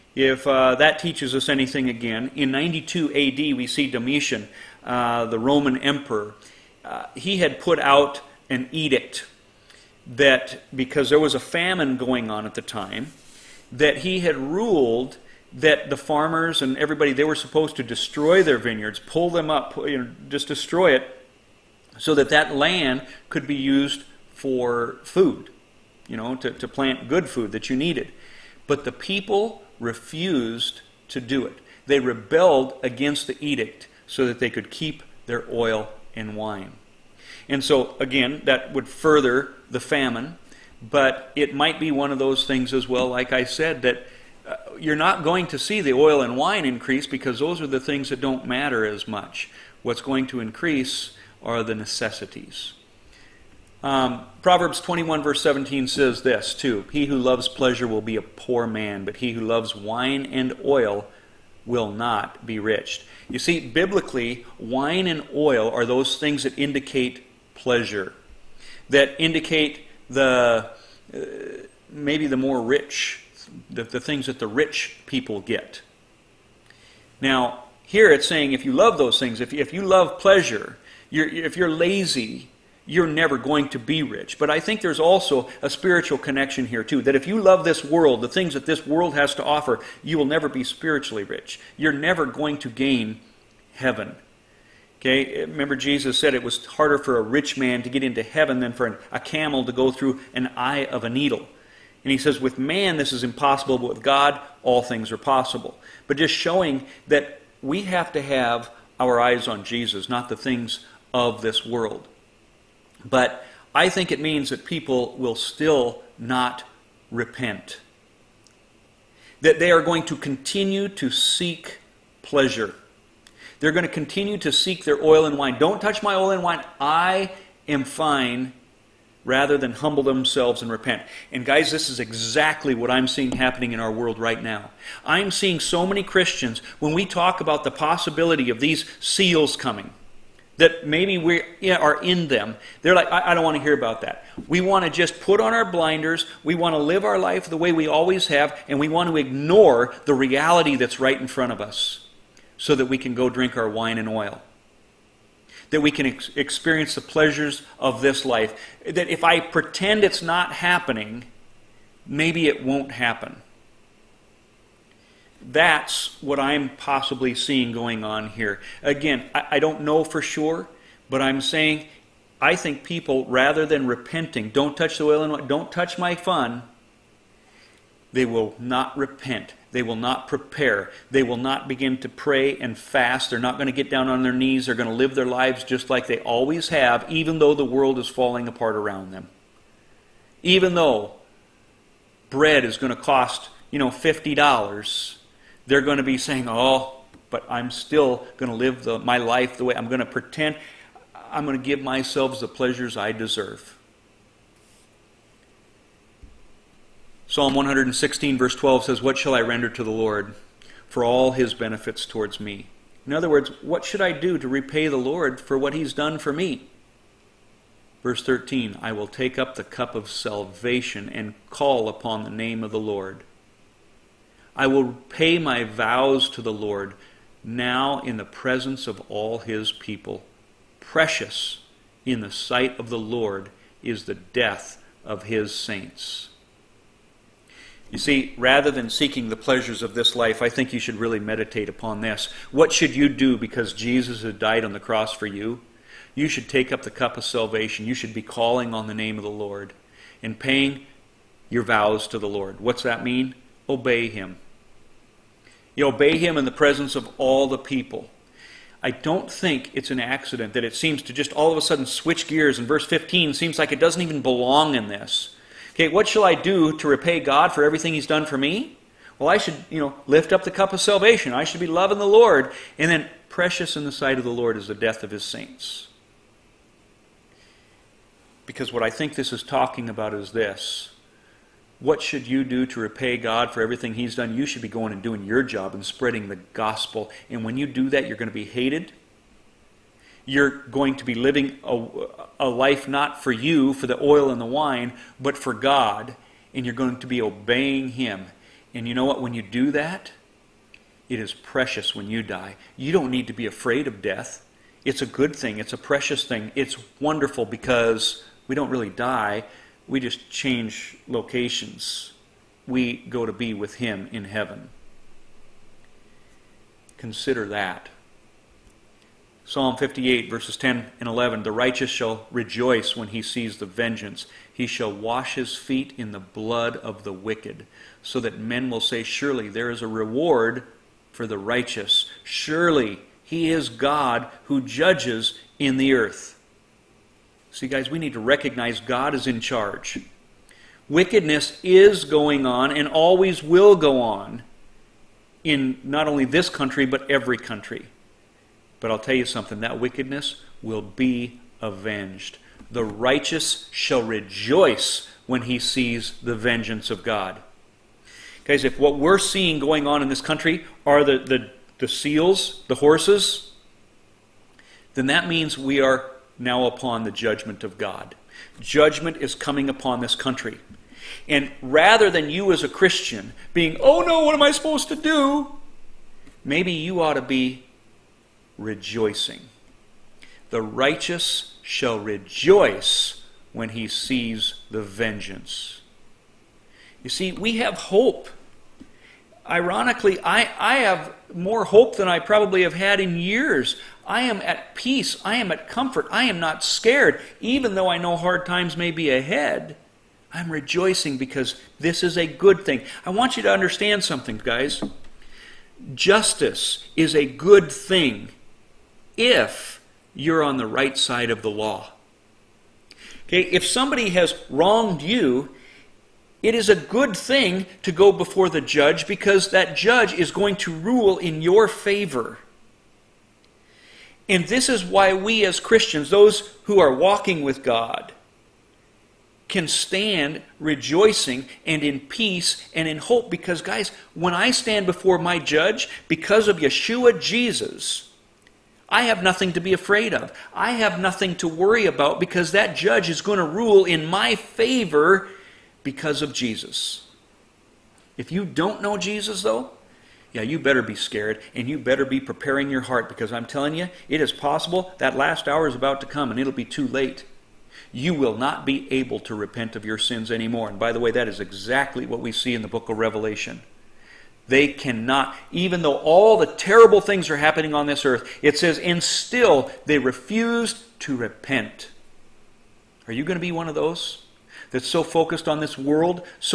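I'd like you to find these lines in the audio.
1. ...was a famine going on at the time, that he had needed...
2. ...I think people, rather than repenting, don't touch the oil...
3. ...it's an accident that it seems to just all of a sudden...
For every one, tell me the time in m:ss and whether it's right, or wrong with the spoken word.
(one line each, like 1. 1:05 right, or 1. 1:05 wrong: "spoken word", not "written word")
1. 0:11 wrong: "ruled", not "needed"
2. 2:52 right
3. 4:19 right.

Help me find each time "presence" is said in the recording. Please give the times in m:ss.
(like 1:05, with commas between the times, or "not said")
3:48, 4:16.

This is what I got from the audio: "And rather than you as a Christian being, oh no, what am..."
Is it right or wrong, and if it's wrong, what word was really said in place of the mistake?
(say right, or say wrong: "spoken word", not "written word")
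right.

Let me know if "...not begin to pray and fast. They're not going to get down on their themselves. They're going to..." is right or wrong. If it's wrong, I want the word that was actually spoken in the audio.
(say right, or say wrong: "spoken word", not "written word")
wrong: "knees", not "themselves".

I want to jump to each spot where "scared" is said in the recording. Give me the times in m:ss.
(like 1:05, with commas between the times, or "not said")
6:36, 7:30.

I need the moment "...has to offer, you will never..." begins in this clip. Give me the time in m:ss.
1:29.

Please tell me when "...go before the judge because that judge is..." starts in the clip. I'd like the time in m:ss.
6:57.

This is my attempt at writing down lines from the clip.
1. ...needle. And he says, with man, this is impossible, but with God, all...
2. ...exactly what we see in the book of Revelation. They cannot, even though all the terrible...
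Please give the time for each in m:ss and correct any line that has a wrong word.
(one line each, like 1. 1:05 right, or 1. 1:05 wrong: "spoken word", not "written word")
1. 1:41 right
2. 7:41 right.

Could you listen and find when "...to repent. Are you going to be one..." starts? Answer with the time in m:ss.
7:51.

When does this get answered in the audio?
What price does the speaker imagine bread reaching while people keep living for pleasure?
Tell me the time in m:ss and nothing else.
3:13.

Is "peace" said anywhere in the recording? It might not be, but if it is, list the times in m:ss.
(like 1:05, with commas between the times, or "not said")
6:34, 7:11.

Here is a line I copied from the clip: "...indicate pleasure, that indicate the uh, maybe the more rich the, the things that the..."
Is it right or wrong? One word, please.
right.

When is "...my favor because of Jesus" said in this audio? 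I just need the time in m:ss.
7:24.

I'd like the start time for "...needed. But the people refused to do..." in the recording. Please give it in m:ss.
0:27.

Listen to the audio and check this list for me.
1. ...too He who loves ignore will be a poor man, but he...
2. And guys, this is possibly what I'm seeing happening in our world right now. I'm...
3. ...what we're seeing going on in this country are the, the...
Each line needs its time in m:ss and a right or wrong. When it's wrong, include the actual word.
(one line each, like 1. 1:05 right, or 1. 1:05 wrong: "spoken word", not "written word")
1. 0:56 wrong: "pleasure", not "ignore"
2. 2:11 wrong: "exactly", not "possibly"
3. 5:58 right.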